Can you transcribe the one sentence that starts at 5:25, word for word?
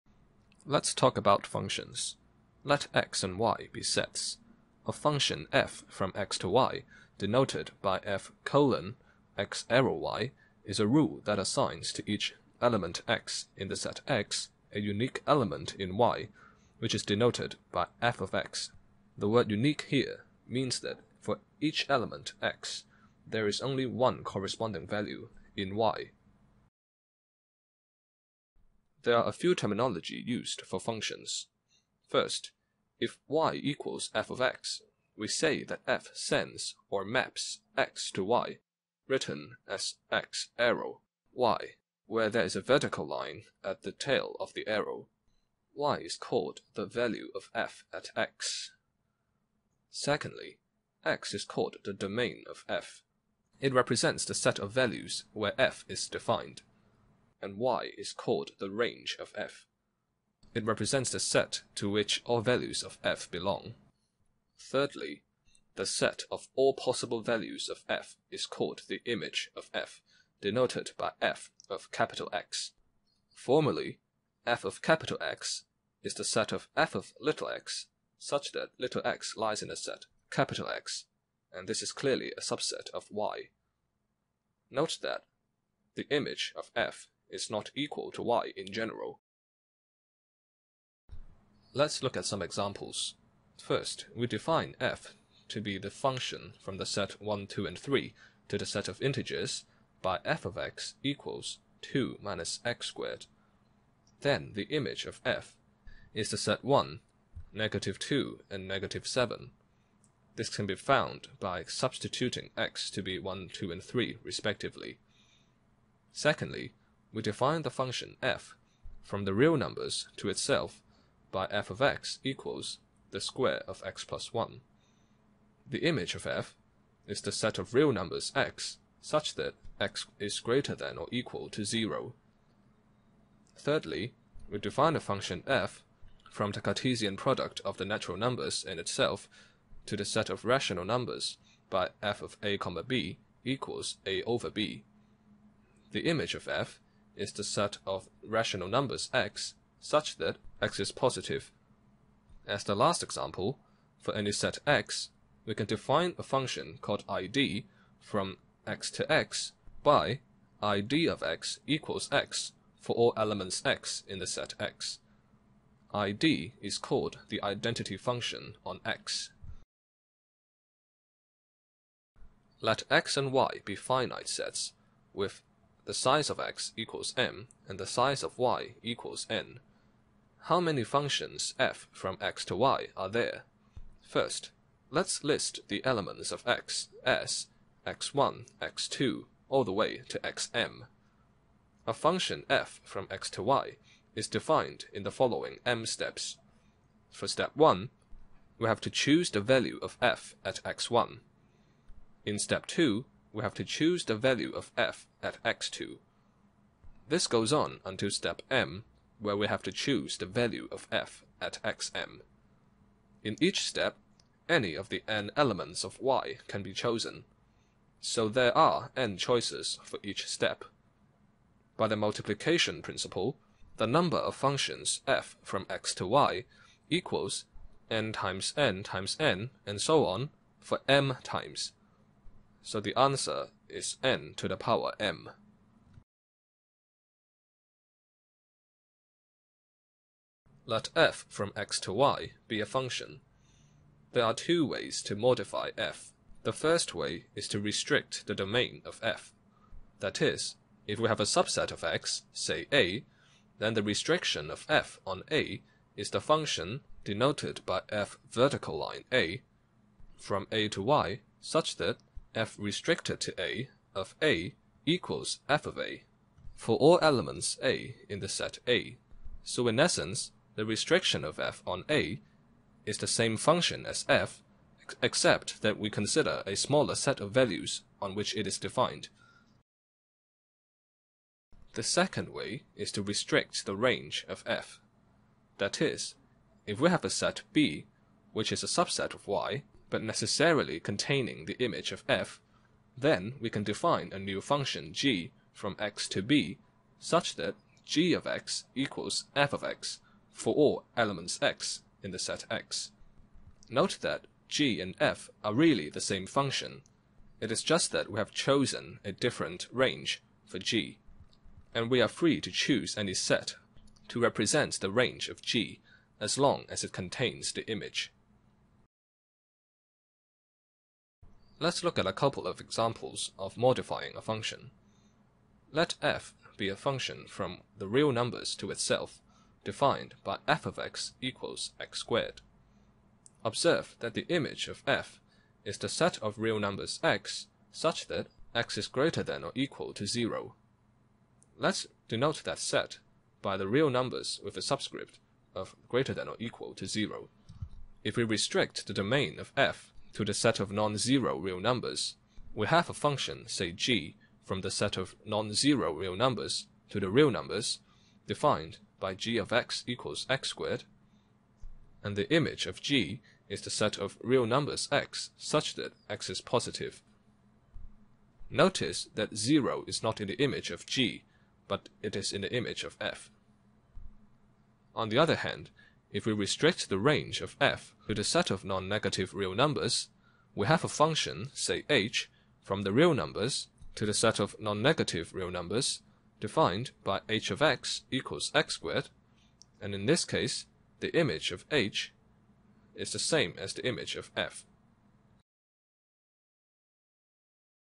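Let f be a function from the real numbers to itself, defined by f of x equals x squared.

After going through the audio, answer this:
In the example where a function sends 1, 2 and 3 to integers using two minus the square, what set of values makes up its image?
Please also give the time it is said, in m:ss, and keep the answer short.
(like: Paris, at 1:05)
1, -2, and -7, at 1:46.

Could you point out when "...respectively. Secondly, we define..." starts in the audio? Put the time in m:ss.
1:54.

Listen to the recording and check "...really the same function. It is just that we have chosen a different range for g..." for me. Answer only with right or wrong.
right.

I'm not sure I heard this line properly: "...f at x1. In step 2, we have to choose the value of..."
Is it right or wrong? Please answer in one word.
right.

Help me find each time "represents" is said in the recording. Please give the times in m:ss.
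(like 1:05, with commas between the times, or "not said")
0:53, 1:00, 5:14.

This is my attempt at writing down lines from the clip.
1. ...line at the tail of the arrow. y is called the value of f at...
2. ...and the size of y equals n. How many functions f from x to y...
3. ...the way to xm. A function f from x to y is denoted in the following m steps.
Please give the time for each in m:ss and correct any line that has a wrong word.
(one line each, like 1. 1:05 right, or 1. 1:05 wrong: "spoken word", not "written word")
1. 0:43 right
2. 2:57 right
3. 3:09 wrong: "defined", not "denoted".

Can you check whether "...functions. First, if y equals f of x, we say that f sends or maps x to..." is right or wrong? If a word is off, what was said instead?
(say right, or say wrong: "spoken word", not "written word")
right.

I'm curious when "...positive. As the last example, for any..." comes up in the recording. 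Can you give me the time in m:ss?
2:30.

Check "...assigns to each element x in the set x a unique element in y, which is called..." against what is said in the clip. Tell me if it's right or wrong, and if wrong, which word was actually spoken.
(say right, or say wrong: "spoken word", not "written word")
wrong: "denoted", not "called".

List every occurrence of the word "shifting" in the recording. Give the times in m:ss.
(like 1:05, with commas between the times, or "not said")
not said.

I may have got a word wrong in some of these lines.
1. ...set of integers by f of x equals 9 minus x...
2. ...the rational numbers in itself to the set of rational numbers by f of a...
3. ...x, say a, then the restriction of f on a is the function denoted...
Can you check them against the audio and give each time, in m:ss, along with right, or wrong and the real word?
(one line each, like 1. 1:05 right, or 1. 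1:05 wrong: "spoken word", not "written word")
1. 1:38 wrong: "2", not "9"
2. 2:17 wrong: "natural", not "rational"
3. 4:11 right.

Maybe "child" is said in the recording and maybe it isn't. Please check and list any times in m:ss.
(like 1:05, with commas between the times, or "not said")
not said.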